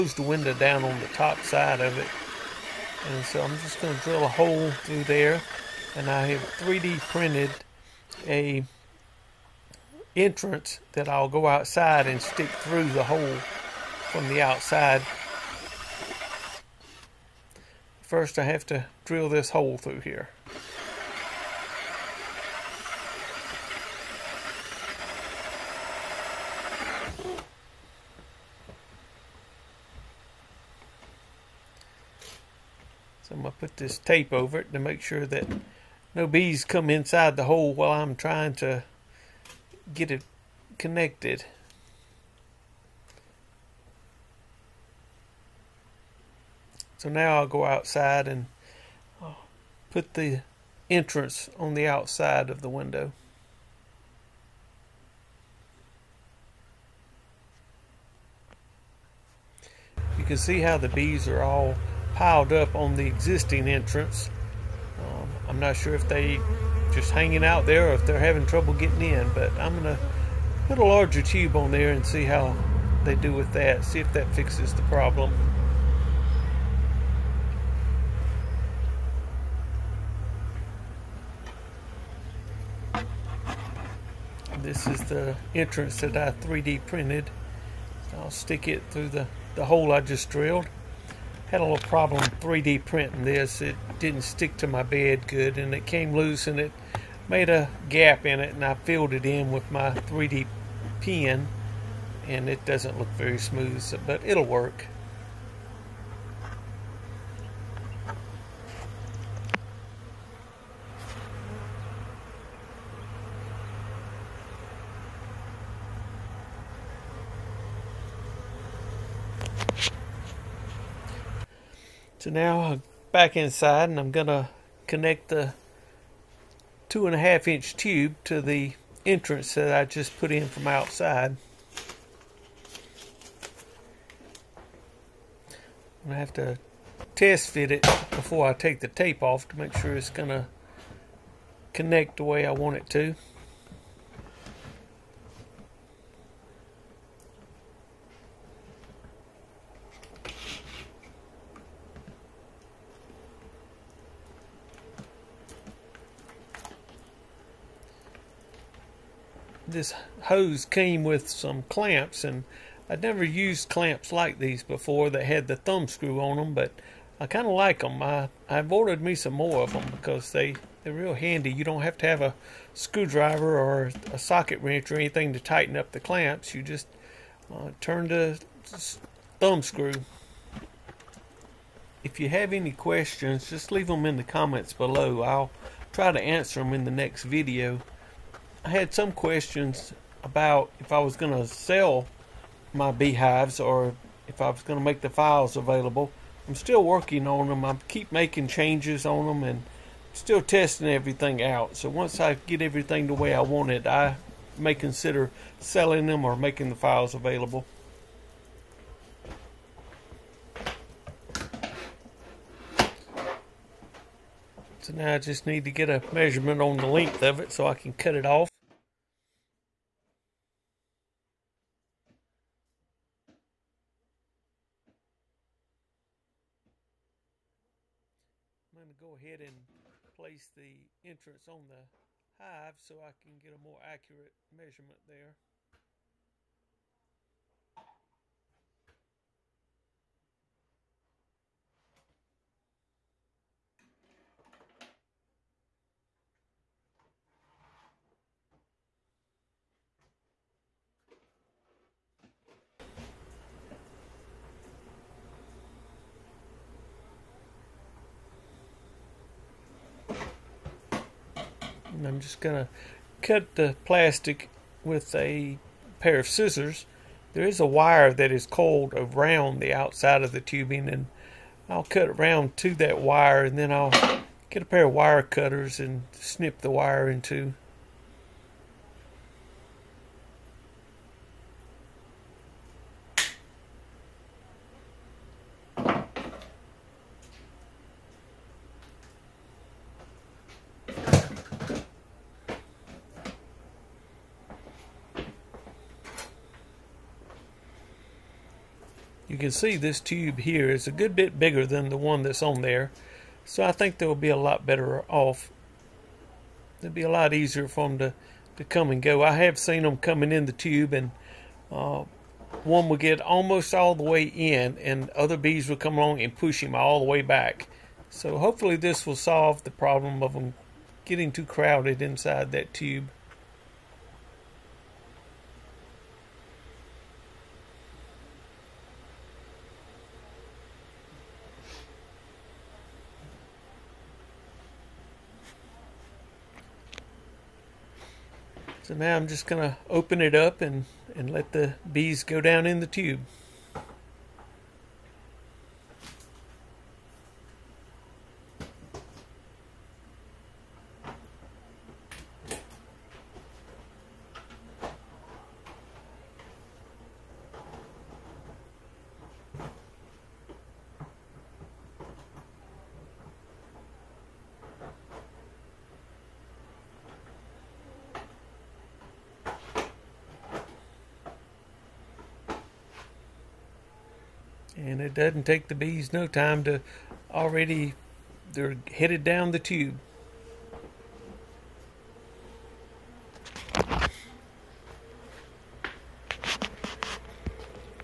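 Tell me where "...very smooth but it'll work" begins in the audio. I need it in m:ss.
1:43.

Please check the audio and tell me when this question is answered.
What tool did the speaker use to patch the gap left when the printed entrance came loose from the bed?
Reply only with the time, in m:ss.
1:39.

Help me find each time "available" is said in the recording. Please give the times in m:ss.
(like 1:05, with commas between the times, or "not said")
3:15, 3:27.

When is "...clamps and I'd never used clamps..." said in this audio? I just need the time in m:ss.
2:41.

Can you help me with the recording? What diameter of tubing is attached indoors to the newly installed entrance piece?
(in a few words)
2.5 inches.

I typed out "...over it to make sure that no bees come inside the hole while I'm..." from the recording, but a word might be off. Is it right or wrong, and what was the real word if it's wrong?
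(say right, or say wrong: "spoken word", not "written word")
right.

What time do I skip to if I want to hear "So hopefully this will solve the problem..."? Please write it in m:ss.
5:18.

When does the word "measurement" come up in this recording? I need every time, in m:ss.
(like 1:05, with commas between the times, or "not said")
3:36, 3:54.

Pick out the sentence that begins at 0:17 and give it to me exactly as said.
First I have to drill this hole through here.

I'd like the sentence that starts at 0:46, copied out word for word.
So now I'll go outside and uh, put the entrance on the outside of the window.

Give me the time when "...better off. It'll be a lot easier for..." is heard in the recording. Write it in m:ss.
5:04.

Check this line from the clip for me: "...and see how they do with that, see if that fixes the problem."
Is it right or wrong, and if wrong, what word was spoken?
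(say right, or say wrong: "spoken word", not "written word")
right.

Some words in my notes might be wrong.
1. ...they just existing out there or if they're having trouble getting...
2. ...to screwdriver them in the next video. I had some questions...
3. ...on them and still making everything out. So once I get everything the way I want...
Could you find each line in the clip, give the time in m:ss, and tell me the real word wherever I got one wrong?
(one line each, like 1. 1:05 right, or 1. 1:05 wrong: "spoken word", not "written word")
1. 1:06 wrong: "hanging", not "existing"
2. 3:06 wrong: "answer", not "screwdriver"
3. 3:19 wrong: "testing", not "making".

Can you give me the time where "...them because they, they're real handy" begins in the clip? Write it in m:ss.
2:49.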